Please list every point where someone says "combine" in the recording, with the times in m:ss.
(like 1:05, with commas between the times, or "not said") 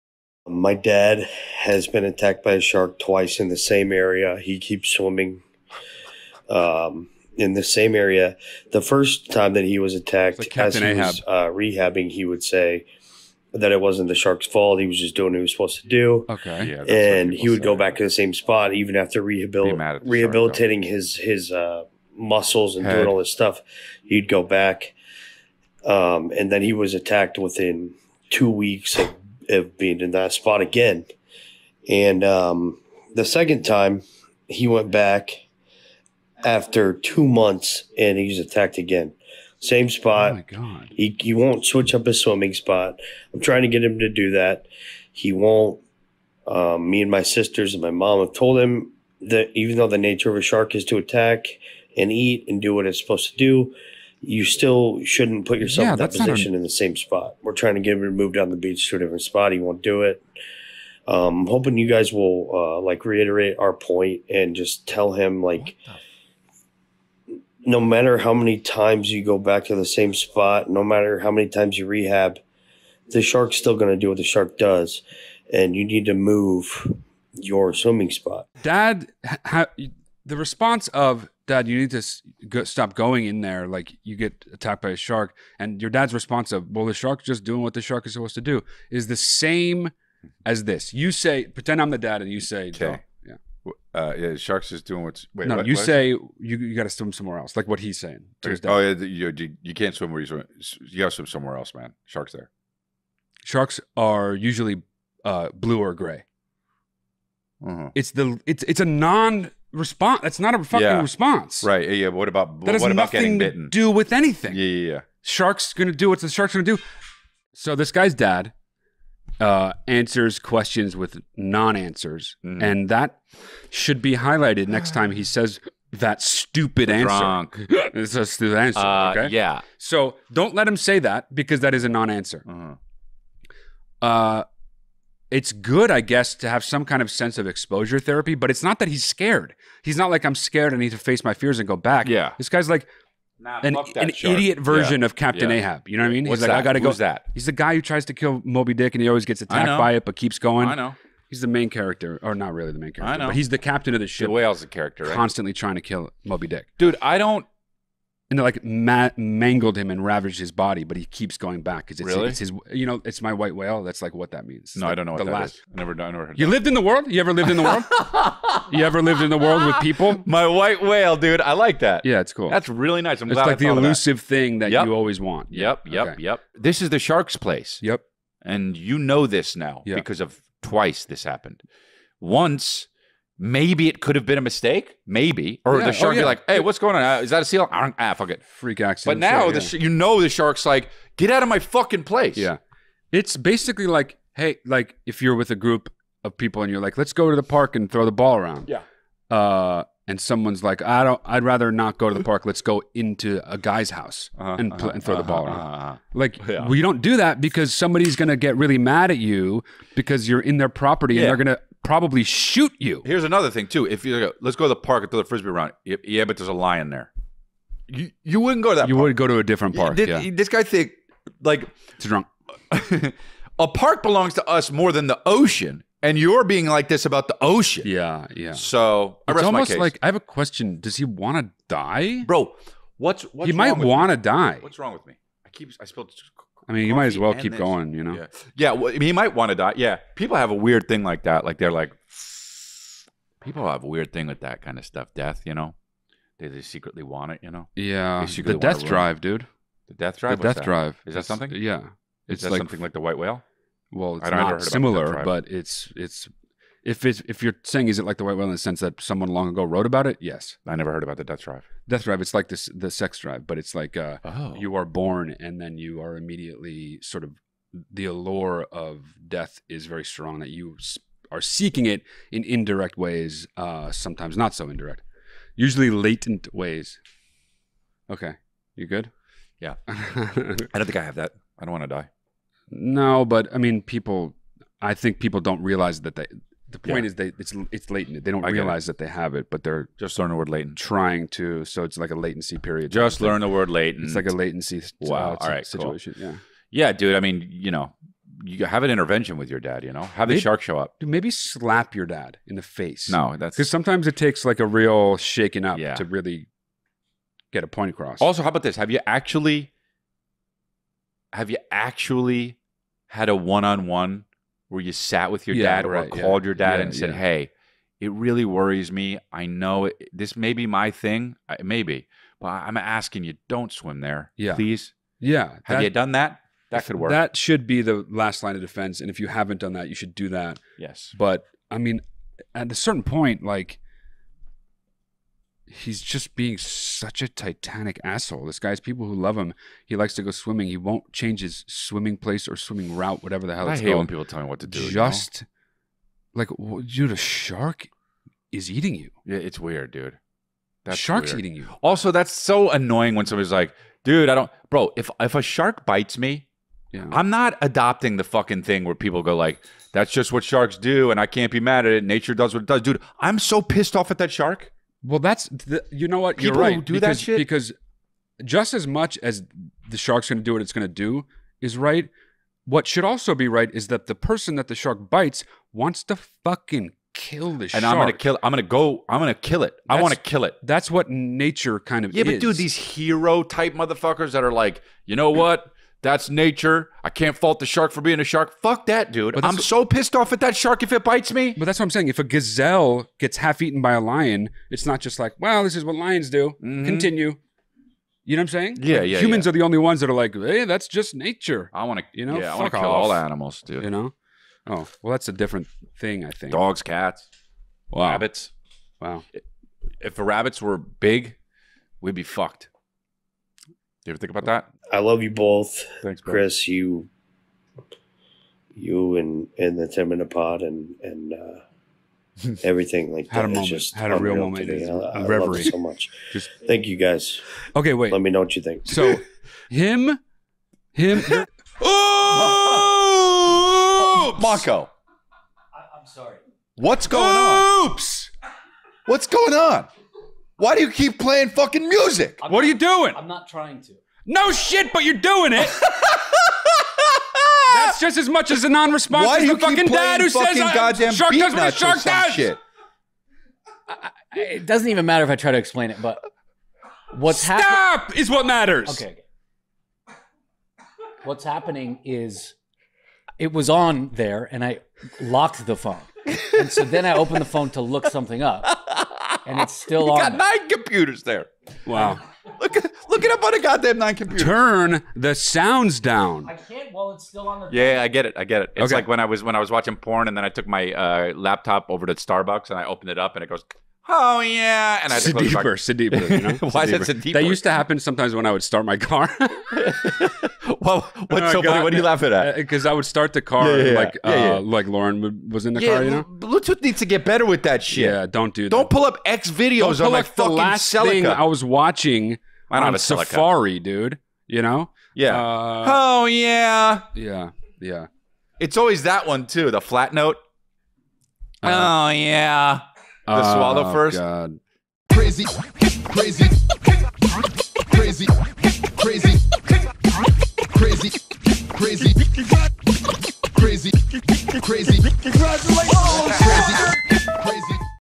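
not said.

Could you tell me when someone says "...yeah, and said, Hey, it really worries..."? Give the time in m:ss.
5:16.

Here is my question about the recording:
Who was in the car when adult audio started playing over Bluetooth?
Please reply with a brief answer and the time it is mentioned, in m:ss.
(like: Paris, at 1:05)
Lauren, at 8:14.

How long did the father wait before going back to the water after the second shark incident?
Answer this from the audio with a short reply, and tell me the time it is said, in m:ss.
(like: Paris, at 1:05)
two months, at 0:36.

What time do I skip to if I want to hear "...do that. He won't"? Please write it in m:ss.
0:44.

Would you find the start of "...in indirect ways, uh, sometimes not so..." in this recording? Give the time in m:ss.
4:32.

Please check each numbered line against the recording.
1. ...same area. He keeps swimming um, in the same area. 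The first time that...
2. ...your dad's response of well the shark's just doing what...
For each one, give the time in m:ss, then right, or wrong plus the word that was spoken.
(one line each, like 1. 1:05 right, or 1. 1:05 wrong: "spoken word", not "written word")
1. 0:03 right
2. 1:25 right.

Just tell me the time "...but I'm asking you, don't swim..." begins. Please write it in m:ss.
5:22.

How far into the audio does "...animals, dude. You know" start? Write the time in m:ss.
6:43.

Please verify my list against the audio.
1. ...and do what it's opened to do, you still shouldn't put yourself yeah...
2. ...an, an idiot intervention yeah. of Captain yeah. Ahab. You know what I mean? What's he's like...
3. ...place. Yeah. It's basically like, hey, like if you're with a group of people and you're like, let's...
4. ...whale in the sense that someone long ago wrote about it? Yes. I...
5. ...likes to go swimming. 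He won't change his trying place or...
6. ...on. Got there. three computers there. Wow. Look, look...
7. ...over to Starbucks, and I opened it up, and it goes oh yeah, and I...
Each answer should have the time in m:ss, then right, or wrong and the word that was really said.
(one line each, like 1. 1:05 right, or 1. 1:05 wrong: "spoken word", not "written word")
1. 0:52 wrong: "supposed", not "opened"
2. 2:23 wrong: "version", not "intervention"
3. 3:12 right
4. 4:18 right
5. 5:39 wrong: "swimming", not "trying"
6. 7:50 wrong: "nine", not "three"
7. 8:01 right.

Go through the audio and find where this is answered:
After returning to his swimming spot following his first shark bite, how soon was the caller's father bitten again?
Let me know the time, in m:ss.
0:27.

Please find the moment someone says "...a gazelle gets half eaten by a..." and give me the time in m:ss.
6:32.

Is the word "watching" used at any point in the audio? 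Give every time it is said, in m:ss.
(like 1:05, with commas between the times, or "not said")
7:59, 8:21.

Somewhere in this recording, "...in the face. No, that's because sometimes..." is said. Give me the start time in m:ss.
5:02.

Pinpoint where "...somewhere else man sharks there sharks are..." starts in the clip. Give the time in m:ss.
1:41.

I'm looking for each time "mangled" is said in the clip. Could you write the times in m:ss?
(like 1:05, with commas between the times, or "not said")
2:39.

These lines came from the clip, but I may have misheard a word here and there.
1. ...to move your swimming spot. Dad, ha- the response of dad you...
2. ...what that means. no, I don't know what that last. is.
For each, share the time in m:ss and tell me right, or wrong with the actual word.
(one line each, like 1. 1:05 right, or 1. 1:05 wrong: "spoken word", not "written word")
1. 1:16 right
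2. 2:44 right.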